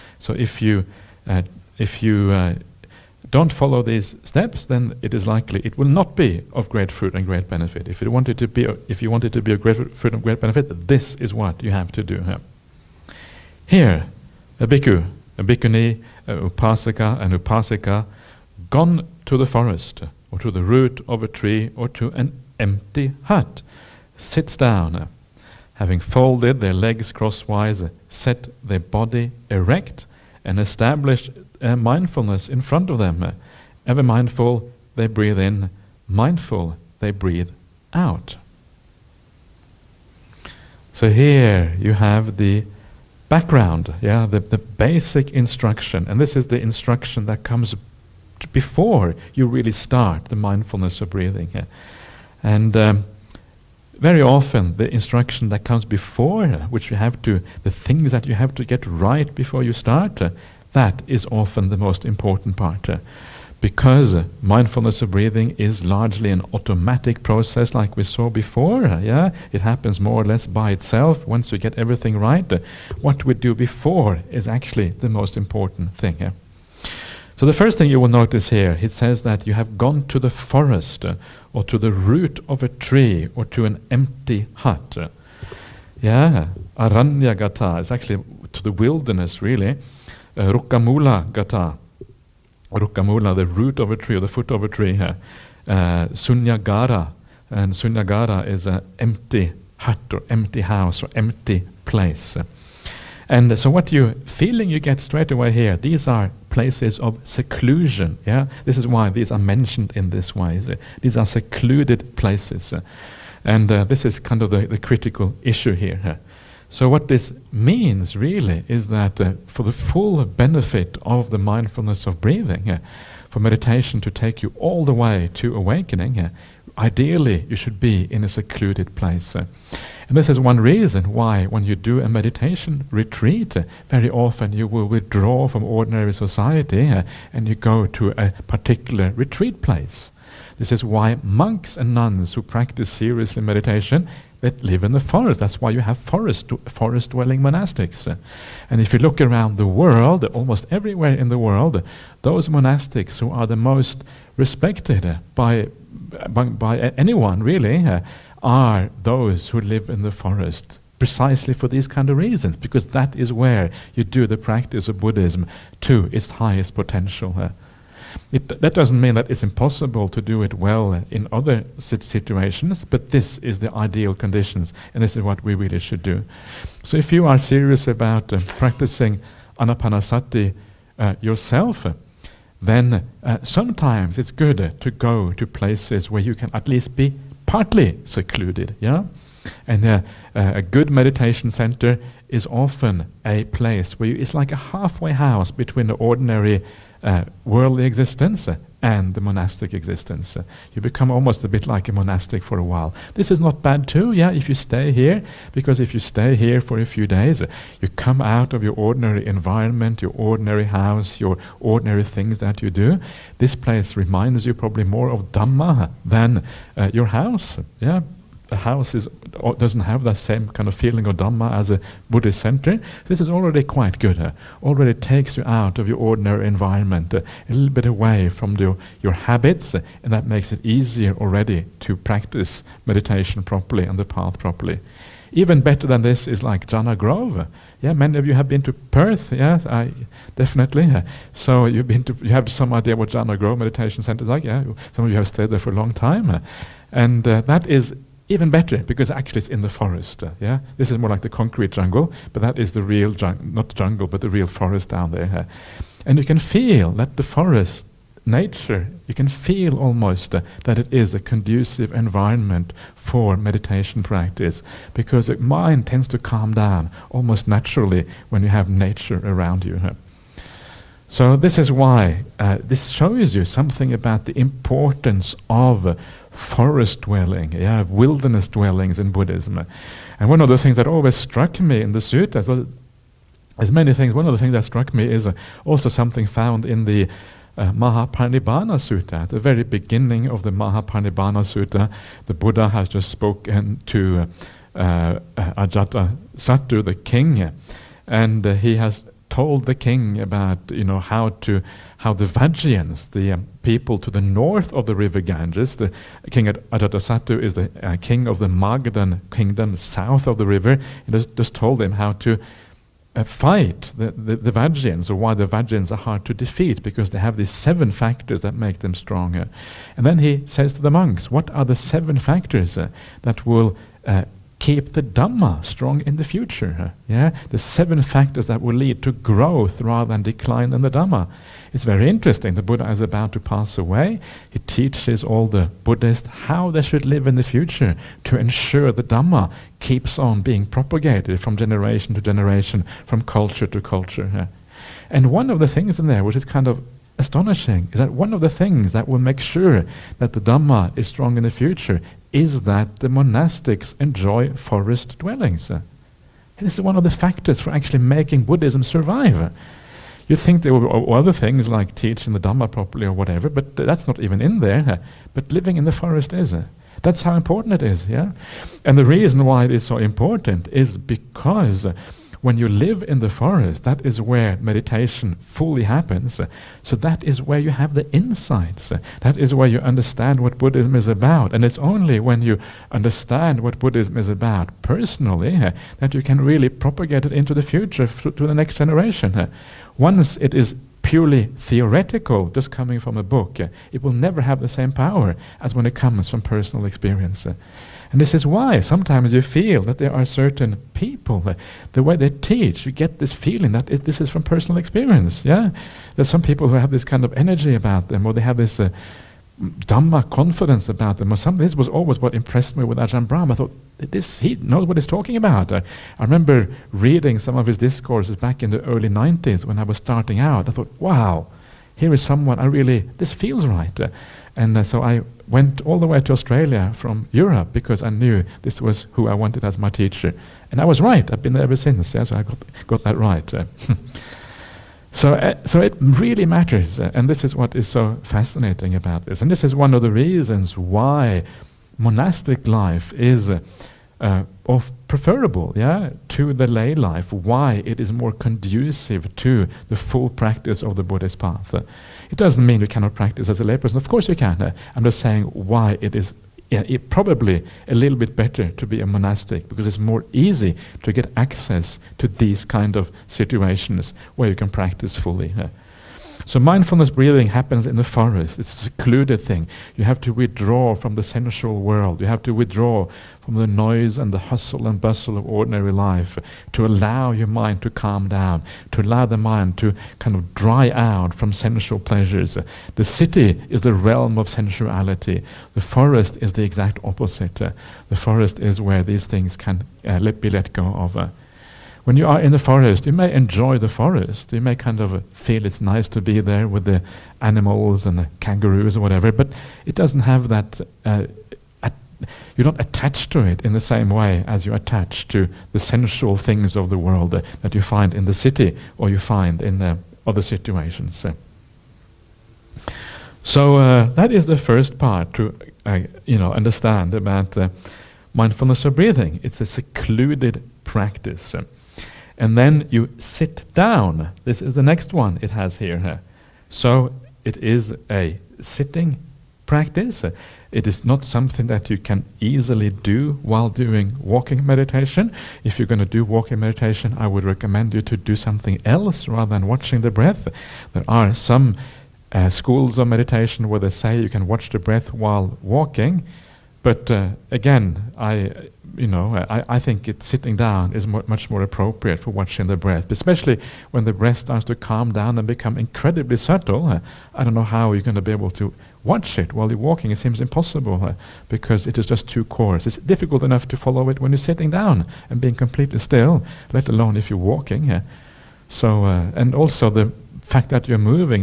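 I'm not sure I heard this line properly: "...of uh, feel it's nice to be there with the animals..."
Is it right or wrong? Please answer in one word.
right.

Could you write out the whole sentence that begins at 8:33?
So uh, that is the first part to uh, you know understand about mindfulness of breathing.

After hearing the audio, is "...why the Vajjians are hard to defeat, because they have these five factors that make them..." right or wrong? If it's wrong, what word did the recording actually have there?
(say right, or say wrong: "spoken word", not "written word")
wrong: "seven", not "five".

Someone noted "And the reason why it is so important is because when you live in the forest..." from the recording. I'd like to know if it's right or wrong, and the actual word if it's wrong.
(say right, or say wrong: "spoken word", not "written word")
right.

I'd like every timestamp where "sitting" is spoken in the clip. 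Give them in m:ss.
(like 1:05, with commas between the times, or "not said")
8:48, 9:10, 9:24.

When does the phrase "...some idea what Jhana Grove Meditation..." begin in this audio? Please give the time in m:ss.
4:02.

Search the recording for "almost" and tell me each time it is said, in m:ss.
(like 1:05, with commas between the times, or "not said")
2:30, 3:21, 4:19, 4:27.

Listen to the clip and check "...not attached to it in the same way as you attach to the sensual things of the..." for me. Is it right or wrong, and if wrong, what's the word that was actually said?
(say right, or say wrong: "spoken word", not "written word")
right.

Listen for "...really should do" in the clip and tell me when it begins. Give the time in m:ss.
2:55.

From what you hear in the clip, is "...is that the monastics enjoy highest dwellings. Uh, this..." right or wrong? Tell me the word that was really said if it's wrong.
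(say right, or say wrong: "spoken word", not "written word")
wrong: "forest", not "highest".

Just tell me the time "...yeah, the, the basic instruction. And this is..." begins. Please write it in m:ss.
0:44.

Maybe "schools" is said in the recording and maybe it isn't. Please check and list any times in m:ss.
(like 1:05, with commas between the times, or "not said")
9:02.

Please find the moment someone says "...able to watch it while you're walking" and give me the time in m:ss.
9:18.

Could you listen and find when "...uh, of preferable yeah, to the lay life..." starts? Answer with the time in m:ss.
7:24.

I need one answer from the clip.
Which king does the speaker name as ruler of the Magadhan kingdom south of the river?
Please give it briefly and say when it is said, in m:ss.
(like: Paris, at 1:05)
Ajatasattu, at 5:06.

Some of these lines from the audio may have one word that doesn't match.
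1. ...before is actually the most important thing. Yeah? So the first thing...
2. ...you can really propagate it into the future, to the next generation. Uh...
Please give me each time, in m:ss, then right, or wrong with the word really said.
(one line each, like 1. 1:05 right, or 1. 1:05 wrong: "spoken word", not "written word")
1. 1:13 right
2. 6:26 right.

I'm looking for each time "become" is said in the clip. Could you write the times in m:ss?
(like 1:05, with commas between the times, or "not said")
3:20, 9:15.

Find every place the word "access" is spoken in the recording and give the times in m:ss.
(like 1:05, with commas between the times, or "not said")
7:41.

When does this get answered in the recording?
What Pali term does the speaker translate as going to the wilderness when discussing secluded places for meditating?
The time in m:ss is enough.
1:26.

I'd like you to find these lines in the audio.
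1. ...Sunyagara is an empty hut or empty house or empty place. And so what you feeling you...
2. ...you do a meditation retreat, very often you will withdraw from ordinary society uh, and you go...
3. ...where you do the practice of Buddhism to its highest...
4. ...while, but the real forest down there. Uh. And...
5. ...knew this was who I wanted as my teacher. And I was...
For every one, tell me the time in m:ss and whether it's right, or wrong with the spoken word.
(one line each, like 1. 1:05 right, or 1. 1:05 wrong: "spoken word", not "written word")
1. 1:37 right
2. 2:11 right
3. 2:43 right
4. 4:13 wrong: "jungle", not "while"
5. 7:08 right.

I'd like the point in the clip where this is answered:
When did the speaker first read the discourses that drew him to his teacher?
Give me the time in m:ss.
6:58.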